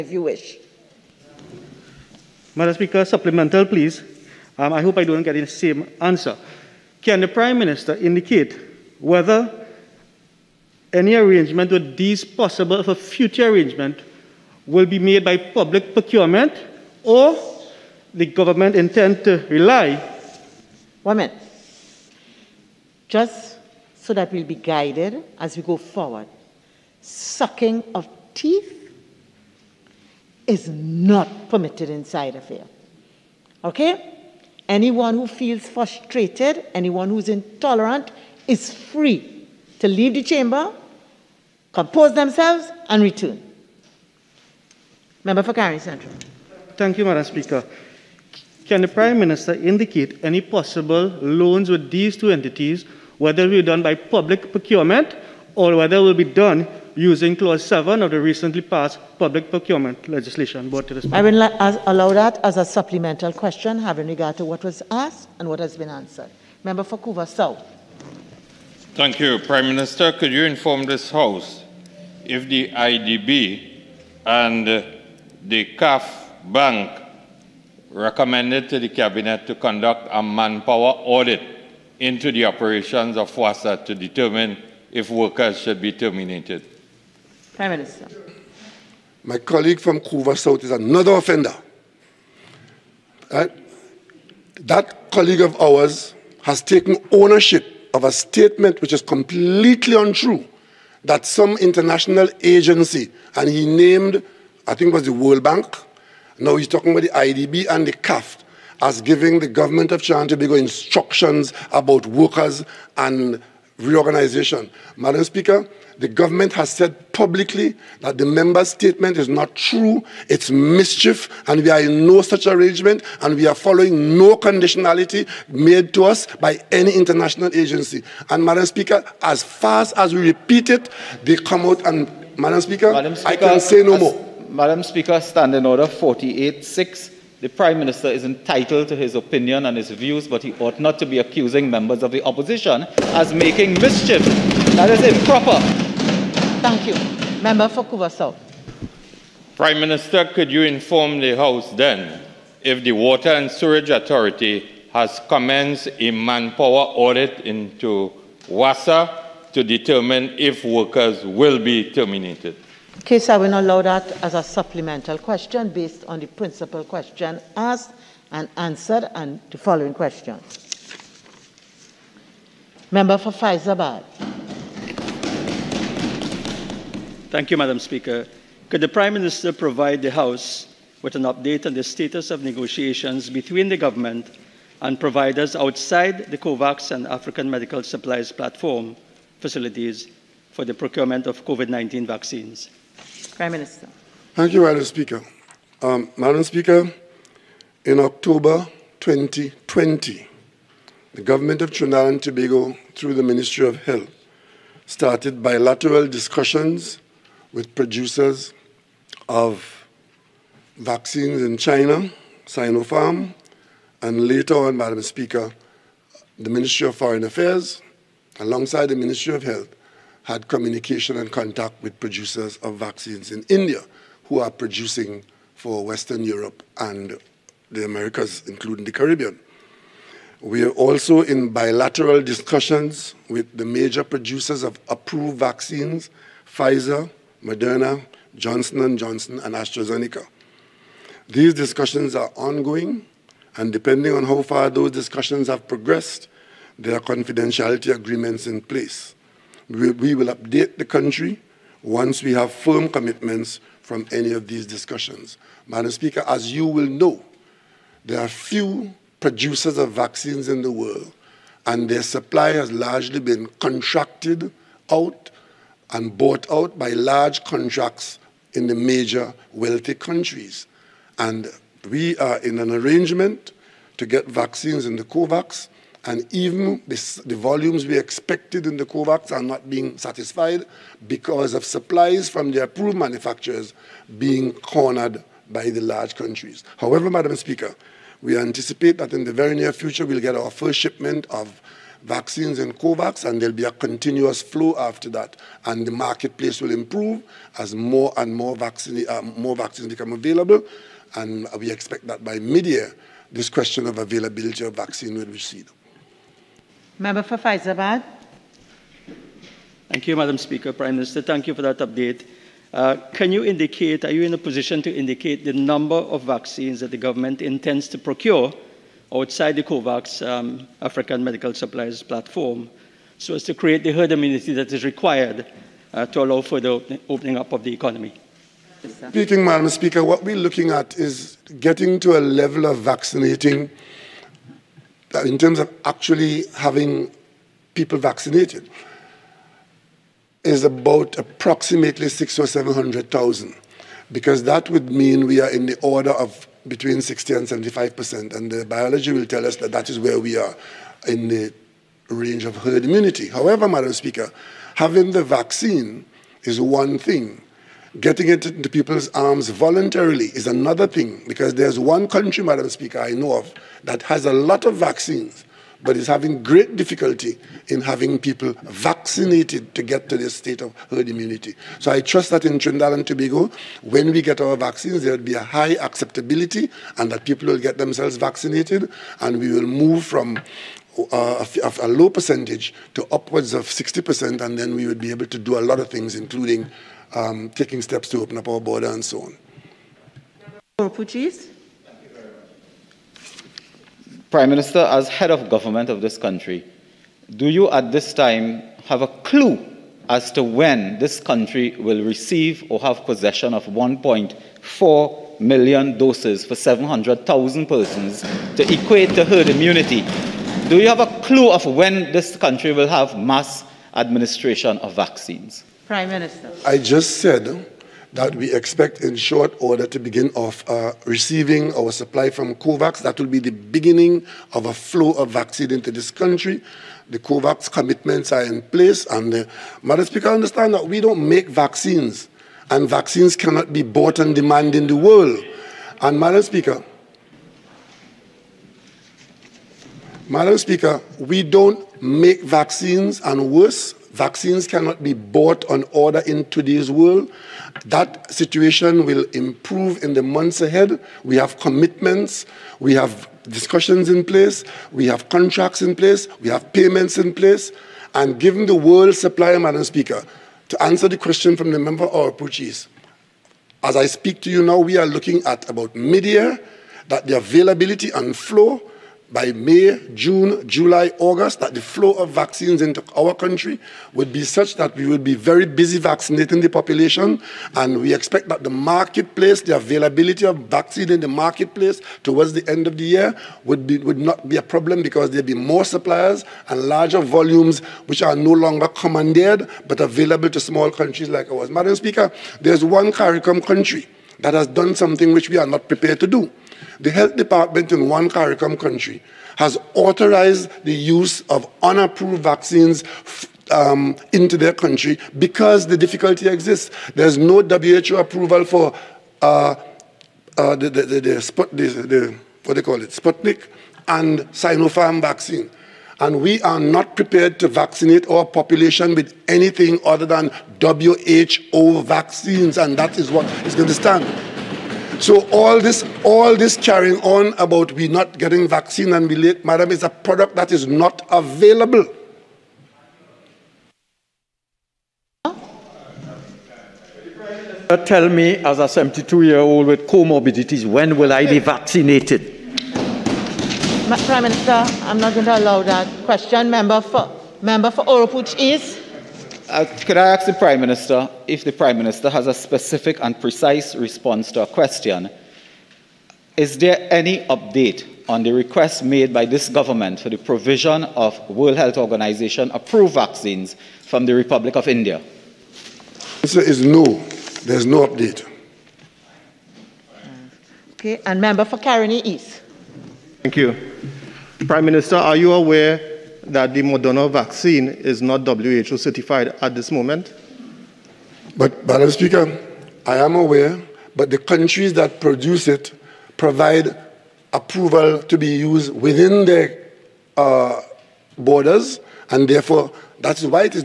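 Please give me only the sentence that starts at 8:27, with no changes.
There's no WHO approval for uh, uh, the, the, the, the, what they call it, Sputnik and Sinopharm vaccine.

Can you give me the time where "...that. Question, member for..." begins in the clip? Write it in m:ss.
9:05.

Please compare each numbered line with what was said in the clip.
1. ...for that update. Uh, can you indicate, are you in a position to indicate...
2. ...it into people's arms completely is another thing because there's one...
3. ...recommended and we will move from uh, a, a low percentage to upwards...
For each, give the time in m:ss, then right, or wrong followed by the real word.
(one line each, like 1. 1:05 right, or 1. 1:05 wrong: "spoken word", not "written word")
1. 5:11 right
2. 5:58 wrong: "voluntarily", not "completely"
3. 6:18 wrong: "vaccinated", not "recommended".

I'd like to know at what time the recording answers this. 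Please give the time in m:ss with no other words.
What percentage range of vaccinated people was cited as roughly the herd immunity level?
5:46.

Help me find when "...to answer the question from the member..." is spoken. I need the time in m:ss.
7:40.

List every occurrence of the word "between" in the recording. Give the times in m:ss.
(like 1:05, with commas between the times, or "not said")
3:03, 5:46.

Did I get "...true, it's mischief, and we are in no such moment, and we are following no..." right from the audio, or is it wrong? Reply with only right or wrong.
wrong.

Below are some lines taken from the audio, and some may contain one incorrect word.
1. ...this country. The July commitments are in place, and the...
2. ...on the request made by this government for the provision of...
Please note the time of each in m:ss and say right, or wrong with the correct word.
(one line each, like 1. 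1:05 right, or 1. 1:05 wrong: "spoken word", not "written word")
1. 7:05 wrong: "COVAX", not "July"
2. 9:18 right.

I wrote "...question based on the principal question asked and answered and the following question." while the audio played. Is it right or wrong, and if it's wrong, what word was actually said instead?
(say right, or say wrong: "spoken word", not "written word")
right.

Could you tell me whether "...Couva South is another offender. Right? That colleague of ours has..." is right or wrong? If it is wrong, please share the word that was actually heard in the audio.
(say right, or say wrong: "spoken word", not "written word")
right.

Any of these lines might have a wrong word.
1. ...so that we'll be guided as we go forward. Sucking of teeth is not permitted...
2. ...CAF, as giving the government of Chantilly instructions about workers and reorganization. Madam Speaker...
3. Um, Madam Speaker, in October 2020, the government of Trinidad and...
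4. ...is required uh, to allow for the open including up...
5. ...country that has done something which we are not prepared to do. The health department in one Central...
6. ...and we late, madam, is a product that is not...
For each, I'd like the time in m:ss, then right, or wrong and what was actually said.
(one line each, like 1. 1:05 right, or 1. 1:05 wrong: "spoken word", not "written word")
1. 0:24 right
2. 1:47 right
3. 3:15 right
4. 5:24 wrong: "opening", not "including"
5. 8:13 wrong: "CARICOM", not "Central"
6. 8:49 right.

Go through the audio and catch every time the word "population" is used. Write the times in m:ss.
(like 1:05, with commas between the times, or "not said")
7:56, 8:38.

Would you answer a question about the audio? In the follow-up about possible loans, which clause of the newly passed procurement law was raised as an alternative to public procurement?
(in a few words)
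Clause 7.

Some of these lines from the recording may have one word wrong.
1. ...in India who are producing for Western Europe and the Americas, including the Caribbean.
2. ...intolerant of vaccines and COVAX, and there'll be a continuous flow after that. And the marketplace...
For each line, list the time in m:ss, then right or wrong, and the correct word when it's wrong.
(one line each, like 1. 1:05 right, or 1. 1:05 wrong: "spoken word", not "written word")
1. 3:43 right
2. 4:50 wrong: "shipment", not "intolerant".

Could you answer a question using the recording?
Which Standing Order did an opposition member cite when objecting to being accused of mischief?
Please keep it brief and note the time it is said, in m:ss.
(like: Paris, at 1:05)
48.6, at 2:15.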